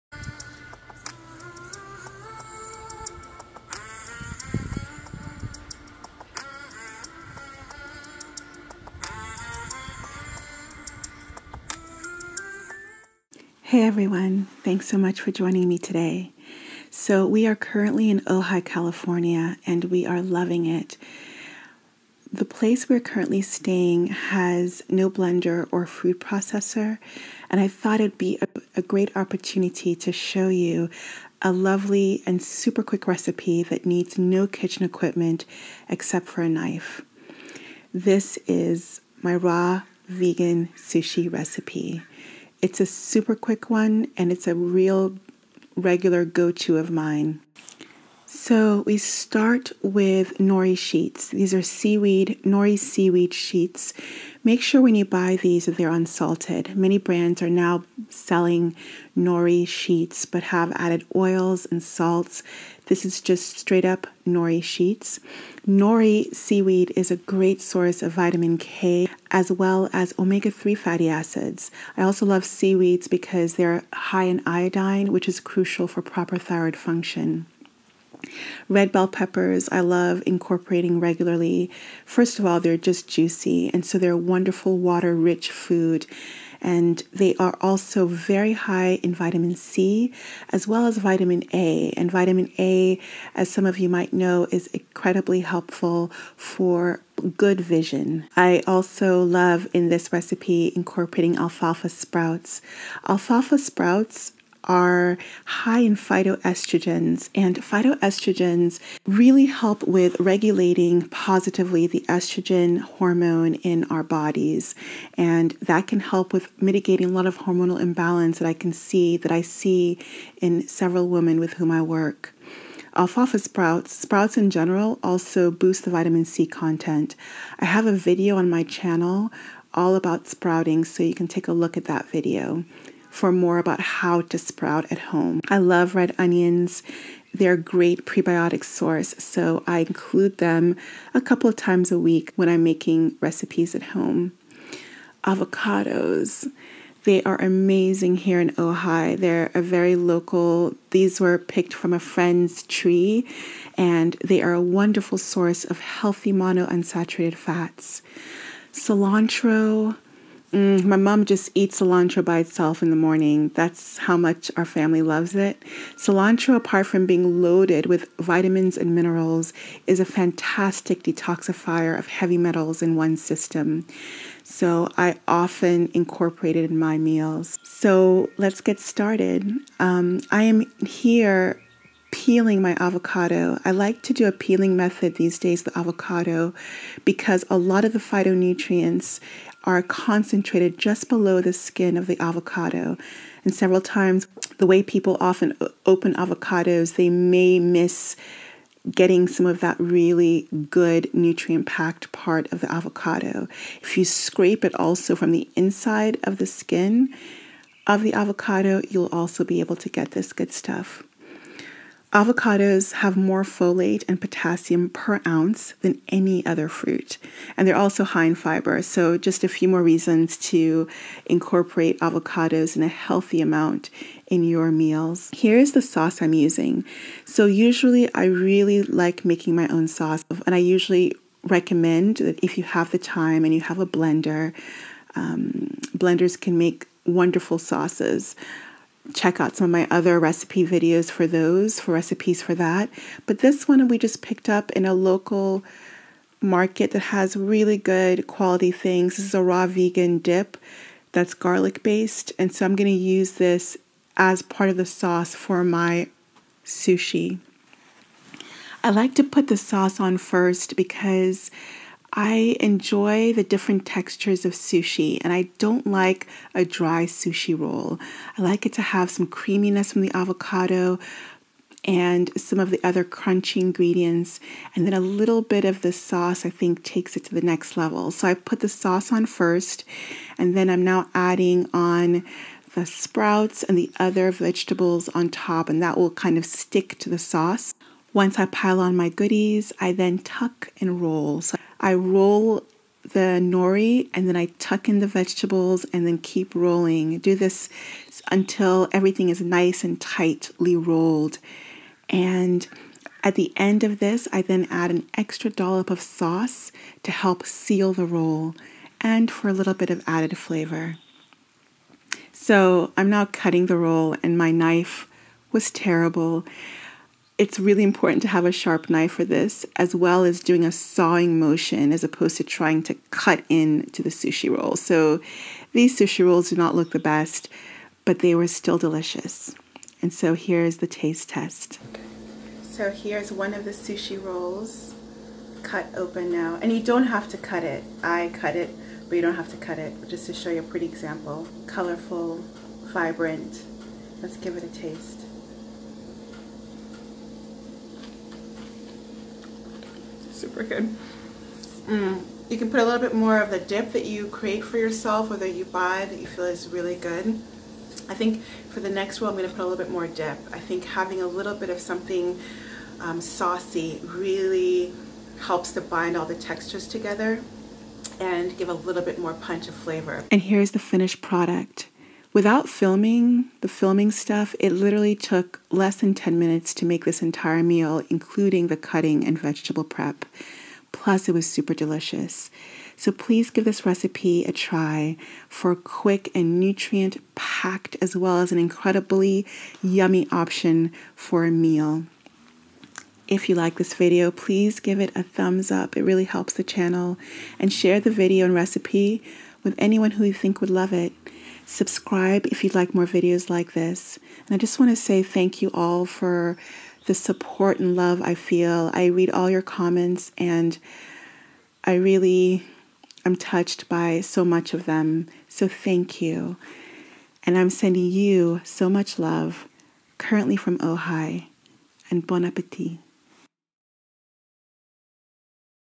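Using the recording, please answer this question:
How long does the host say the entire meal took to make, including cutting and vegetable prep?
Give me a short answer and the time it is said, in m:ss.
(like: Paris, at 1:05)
Less than 10 minutes, at 6:15.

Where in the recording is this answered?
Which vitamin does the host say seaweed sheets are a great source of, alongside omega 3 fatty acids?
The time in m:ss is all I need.
1:08.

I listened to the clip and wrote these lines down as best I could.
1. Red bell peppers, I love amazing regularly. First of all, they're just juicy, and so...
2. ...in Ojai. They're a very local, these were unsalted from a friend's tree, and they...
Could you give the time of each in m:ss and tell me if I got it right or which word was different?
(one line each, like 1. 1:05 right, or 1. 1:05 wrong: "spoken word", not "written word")
1. 1:18 wrong: "incorporating", not "amazing"
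2. 2:28 wrong: "picked", not "unsalted".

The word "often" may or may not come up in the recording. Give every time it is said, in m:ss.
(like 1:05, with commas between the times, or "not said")
2:55, 3:15.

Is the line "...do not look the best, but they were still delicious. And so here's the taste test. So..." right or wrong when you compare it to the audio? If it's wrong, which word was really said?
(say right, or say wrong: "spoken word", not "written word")
right.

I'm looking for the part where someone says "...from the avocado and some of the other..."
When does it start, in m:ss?
4:29.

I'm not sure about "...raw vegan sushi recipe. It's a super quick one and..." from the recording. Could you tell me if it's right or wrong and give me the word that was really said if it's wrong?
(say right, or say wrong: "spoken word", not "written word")
right.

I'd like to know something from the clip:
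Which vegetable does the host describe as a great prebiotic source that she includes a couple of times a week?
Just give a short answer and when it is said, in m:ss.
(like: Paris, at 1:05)
Red onions, at 2:15.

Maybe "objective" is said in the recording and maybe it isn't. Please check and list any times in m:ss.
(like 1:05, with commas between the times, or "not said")
not said.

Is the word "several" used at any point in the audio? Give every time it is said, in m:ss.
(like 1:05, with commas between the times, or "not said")
2:00, 3:13.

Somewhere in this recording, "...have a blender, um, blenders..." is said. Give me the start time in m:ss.
3:53.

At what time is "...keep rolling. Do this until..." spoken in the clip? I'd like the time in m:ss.
4:56.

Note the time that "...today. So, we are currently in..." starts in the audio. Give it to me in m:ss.
0:15.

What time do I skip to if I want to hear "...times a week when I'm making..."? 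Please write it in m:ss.
2:21.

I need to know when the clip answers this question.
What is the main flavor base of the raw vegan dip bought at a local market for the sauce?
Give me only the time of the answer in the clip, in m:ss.
4:11.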